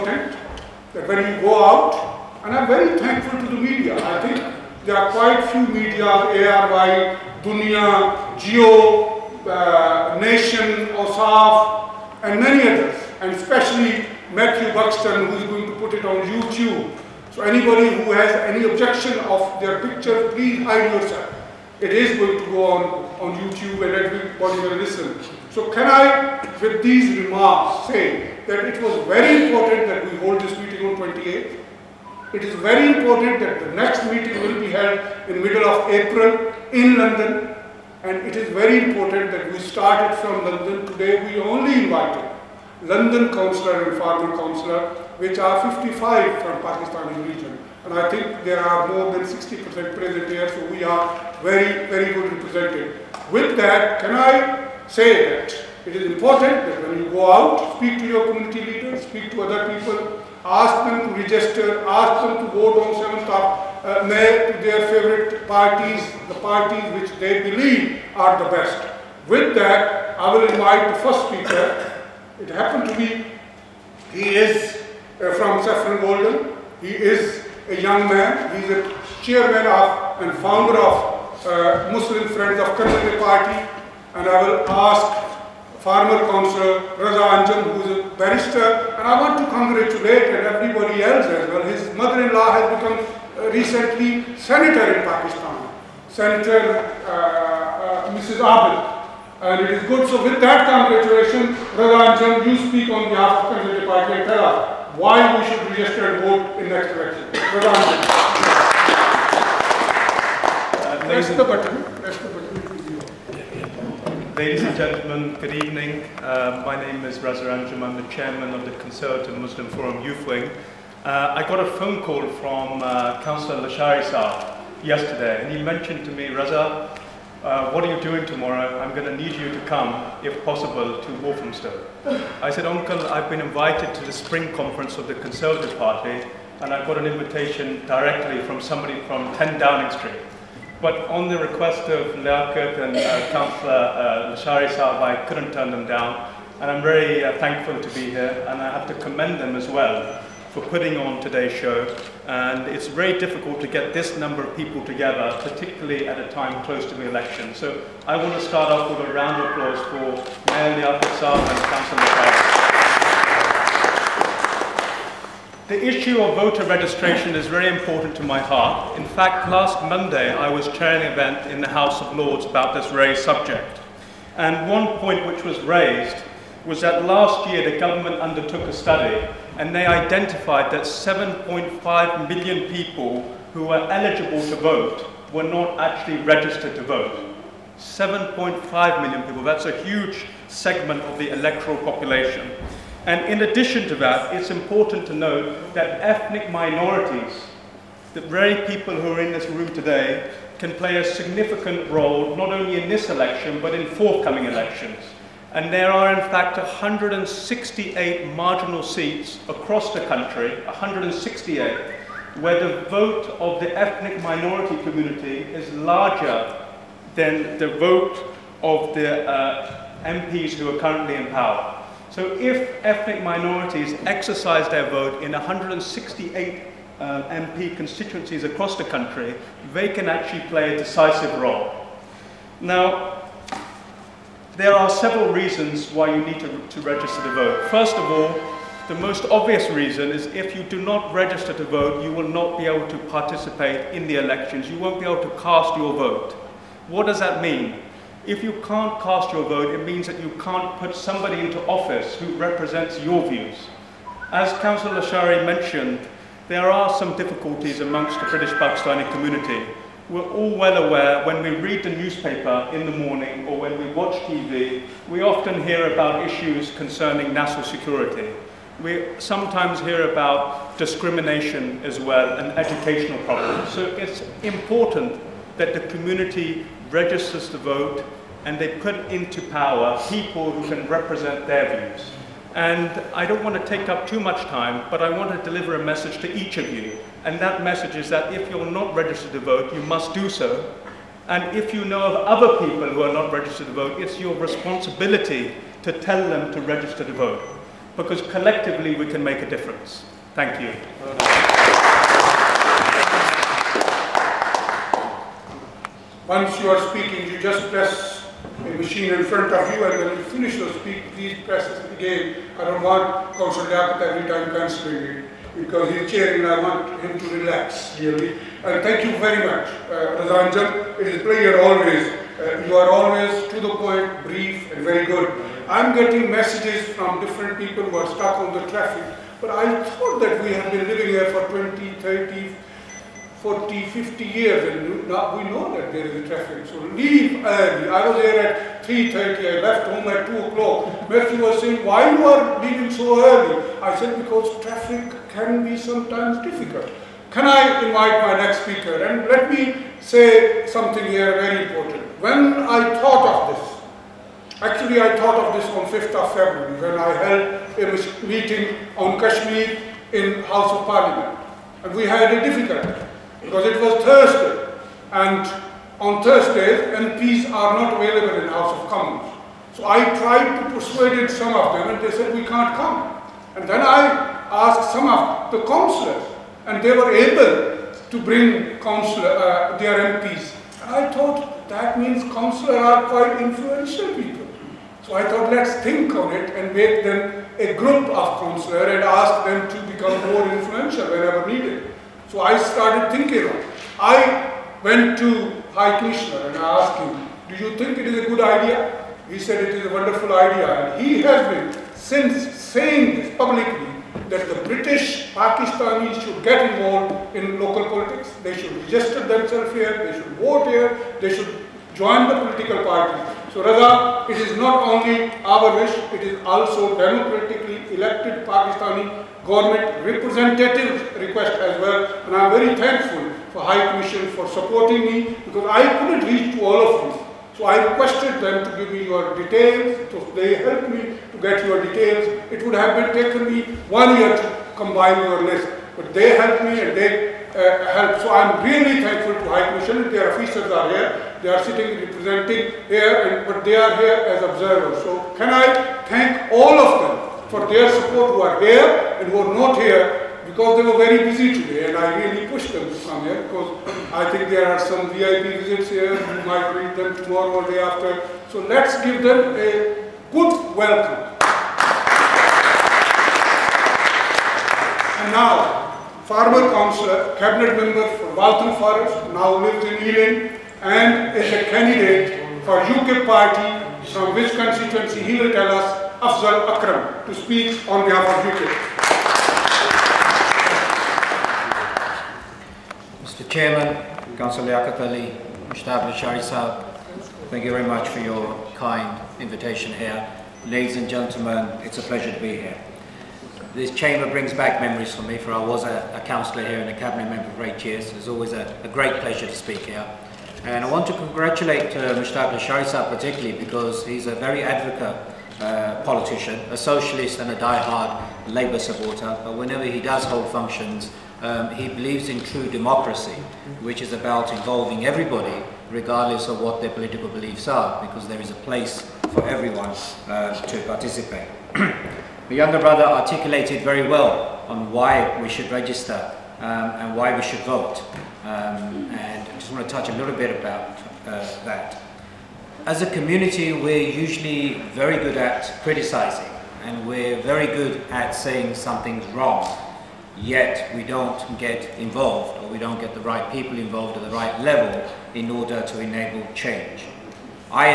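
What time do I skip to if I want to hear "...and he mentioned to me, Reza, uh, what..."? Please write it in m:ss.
2:05.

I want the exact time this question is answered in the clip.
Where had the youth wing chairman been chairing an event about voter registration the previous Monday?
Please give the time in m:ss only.
2:51.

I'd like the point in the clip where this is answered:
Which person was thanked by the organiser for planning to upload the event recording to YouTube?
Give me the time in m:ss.
0:14.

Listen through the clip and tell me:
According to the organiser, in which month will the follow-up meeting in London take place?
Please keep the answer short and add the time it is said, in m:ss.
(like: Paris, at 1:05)
April, at 0:35.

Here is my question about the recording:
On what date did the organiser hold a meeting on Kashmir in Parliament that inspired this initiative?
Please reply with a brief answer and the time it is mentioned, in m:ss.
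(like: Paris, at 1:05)
5th of February, at 5:55.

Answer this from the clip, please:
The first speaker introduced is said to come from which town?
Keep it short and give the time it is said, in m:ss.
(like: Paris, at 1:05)
Saffron Walden, at 1:15.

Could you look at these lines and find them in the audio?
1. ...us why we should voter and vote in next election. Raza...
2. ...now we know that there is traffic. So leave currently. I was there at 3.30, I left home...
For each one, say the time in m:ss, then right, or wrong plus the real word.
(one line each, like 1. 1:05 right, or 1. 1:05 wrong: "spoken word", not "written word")
1. 1:44 wrong: "register", not "voter"
2. 5:35 wrong: "early", not "currently".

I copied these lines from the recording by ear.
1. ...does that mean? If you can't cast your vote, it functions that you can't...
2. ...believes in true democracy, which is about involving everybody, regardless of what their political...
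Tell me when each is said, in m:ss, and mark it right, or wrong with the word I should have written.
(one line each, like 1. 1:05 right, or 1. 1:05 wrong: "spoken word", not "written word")
1. 4:07 wrong: "means", not "functions"
2. 8:31 right.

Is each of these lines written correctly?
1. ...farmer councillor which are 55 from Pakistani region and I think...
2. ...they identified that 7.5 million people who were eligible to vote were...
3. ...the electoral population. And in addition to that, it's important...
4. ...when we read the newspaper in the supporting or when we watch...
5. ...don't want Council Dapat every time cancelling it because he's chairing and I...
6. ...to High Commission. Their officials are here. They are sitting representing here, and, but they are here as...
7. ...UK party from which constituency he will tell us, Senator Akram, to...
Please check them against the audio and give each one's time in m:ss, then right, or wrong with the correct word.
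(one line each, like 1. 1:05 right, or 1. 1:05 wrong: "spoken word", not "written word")
1. 0:43 right
2. 2:59 right
3. 3:11 right
4. 4:21 wrong: "morning", not "supporting"
5. 5:12 right
6. 7:19 right
7. 7:52 wrong: "Afzal", not "Senator".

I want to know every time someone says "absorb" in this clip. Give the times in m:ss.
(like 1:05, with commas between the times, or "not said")
not said.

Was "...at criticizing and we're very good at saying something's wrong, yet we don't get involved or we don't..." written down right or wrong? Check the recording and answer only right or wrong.
right.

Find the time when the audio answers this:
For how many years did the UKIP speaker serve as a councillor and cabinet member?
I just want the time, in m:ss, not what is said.
8:17.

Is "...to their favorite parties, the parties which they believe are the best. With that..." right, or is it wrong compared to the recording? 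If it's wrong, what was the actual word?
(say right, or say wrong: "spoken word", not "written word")
right.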